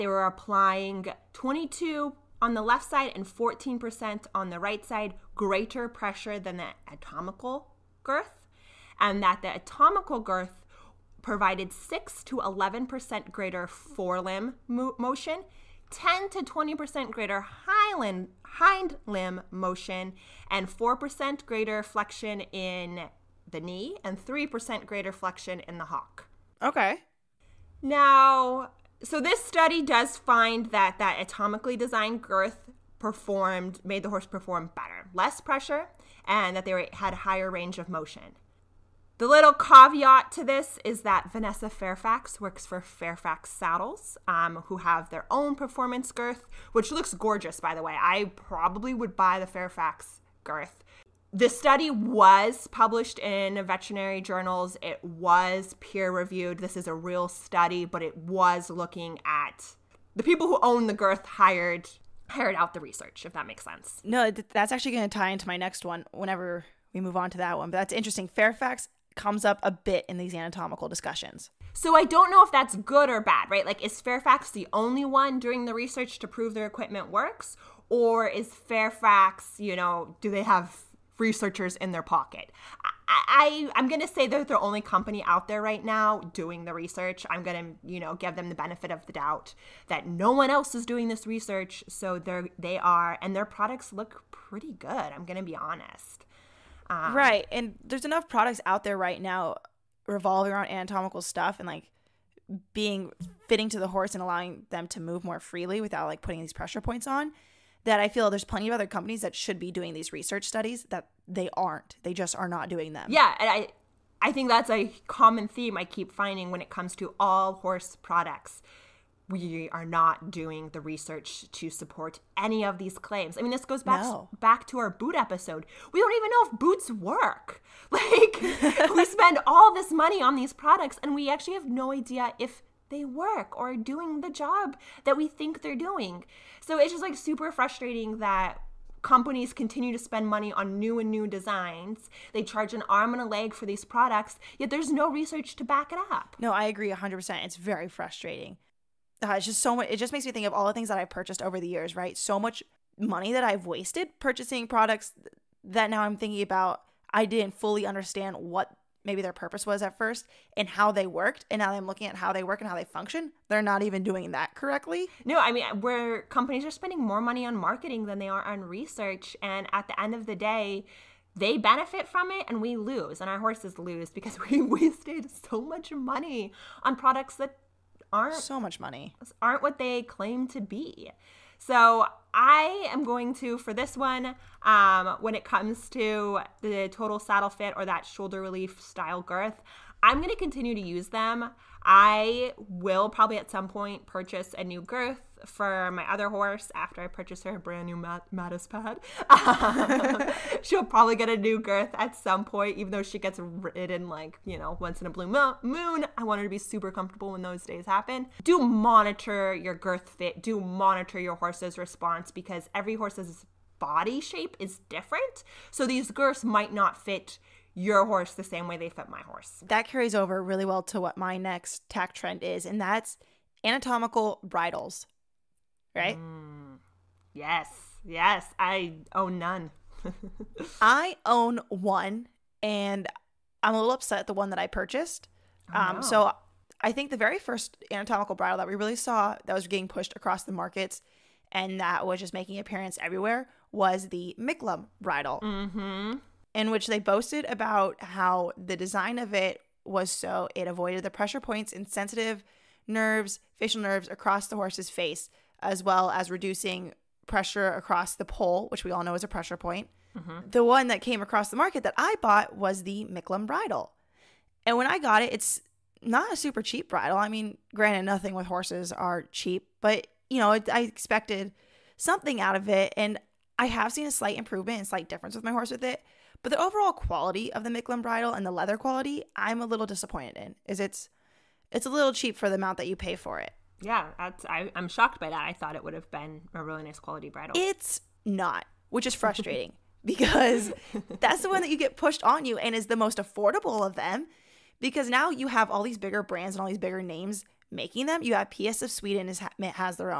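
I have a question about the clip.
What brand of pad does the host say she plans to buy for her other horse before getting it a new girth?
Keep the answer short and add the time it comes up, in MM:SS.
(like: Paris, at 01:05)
Mattes, at 03:18.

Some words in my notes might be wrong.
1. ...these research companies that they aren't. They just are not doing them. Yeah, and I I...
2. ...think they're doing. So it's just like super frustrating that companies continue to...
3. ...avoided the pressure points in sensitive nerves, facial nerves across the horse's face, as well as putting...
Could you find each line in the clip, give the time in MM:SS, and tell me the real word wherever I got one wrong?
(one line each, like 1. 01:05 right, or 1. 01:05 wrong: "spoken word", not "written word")
1. 01:49 wrong: "studies", not "companies"
2. 02:15 right
3. 04:10 wrong: "reducing", not "putting".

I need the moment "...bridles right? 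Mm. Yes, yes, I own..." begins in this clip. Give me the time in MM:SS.
03:44.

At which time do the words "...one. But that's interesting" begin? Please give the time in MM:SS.
01:07.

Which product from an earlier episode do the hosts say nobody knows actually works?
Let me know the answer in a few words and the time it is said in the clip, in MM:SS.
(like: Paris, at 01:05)
boots, at 02:04.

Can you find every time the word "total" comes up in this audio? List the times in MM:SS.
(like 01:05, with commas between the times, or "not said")
03:06.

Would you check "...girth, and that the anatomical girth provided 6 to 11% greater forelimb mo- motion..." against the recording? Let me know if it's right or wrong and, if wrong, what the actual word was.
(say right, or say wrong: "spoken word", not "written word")
right.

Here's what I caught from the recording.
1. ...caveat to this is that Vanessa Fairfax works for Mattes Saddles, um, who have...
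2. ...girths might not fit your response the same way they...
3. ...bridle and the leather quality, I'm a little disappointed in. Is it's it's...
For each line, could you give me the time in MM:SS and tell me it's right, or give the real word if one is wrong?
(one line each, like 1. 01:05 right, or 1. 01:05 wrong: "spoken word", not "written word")
1. 00:39 wrong: "Fairfax", not "Mattes"
2. 03:36 wrong: "horse", not "response"
3. 04:38 right.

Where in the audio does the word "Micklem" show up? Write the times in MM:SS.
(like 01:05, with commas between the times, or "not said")
04:04, 04:23, 04:37.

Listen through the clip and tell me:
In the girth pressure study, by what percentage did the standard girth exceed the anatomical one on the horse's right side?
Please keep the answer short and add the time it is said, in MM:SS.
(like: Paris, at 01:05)
14%, at 00:03.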